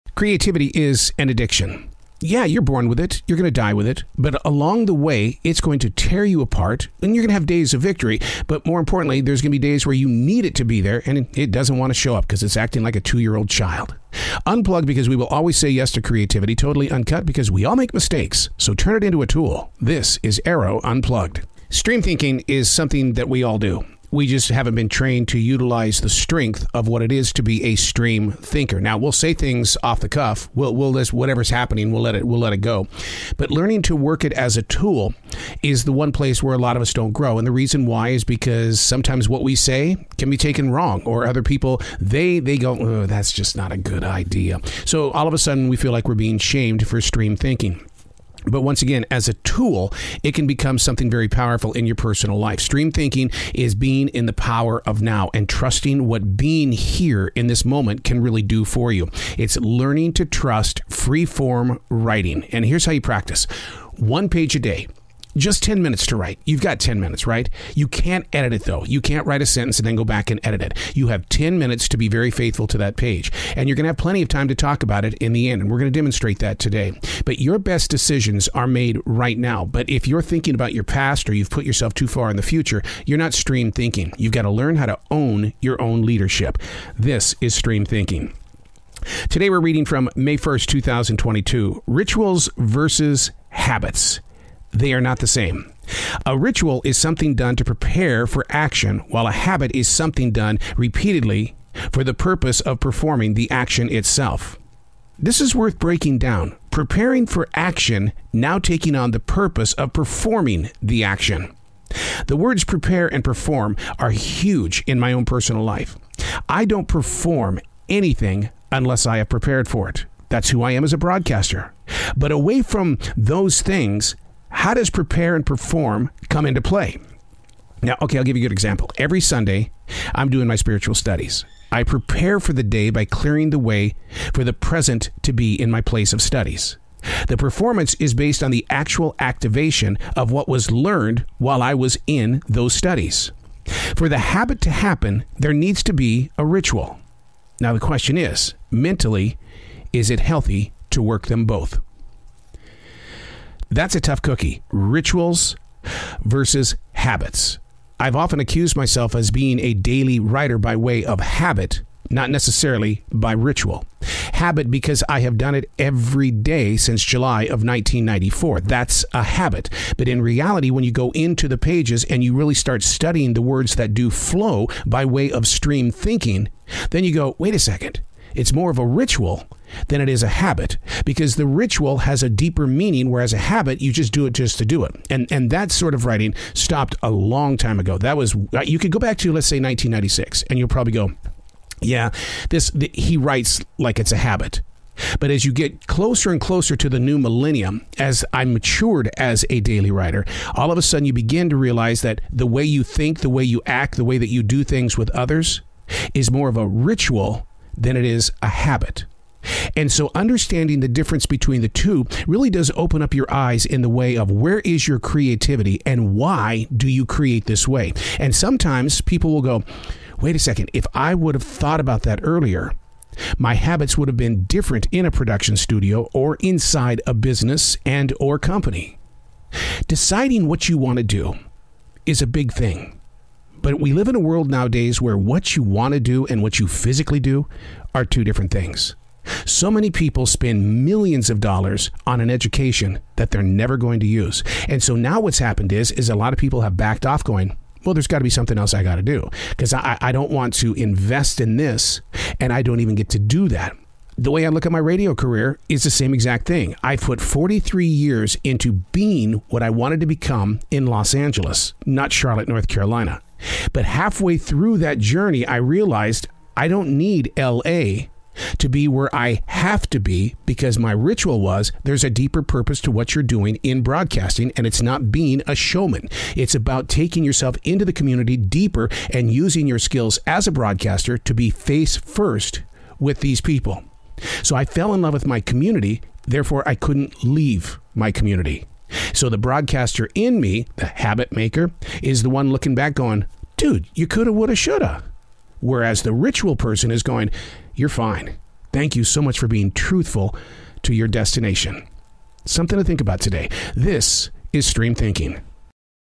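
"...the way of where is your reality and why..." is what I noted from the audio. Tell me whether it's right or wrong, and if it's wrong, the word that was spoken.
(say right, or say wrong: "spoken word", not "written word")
wrong: "creativity", not "reality".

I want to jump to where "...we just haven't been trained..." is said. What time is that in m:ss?
0:24.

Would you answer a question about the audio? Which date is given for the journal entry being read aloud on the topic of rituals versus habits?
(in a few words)
May 1st, 2022.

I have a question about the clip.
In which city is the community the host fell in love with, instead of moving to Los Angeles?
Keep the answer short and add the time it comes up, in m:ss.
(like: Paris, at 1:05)
Charlotte, North Carolina, at 4:22.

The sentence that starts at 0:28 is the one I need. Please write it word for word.
Now we'll say things off the cuff.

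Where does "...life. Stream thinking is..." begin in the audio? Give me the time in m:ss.
0:52.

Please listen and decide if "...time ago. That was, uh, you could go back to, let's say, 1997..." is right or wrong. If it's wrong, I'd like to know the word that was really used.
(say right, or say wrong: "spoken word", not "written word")
wrong: "1996", not "1997".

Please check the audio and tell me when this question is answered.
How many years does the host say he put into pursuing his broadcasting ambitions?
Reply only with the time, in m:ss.
4:17.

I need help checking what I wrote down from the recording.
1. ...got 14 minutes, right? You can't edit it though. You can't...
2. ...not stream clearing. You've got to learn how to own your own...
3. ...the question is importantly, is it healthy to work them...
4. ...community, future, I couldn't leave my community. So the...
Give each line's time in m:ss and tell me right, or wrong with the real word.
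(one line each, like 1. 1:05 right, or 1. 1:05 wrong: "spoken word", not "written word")
1. 1:06 wrong: "10", not "14"
2. 1:23 wrong: "thinking", not "clearing"
3. 2:27 wrong: "mentally", not "importantly"
4. 4:45 wrong: "therefore", not "future".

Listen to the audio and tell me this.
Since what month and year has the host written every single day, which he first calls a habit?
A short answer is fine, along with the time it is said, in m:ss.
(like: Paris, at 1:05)
July 1994, at 2:47.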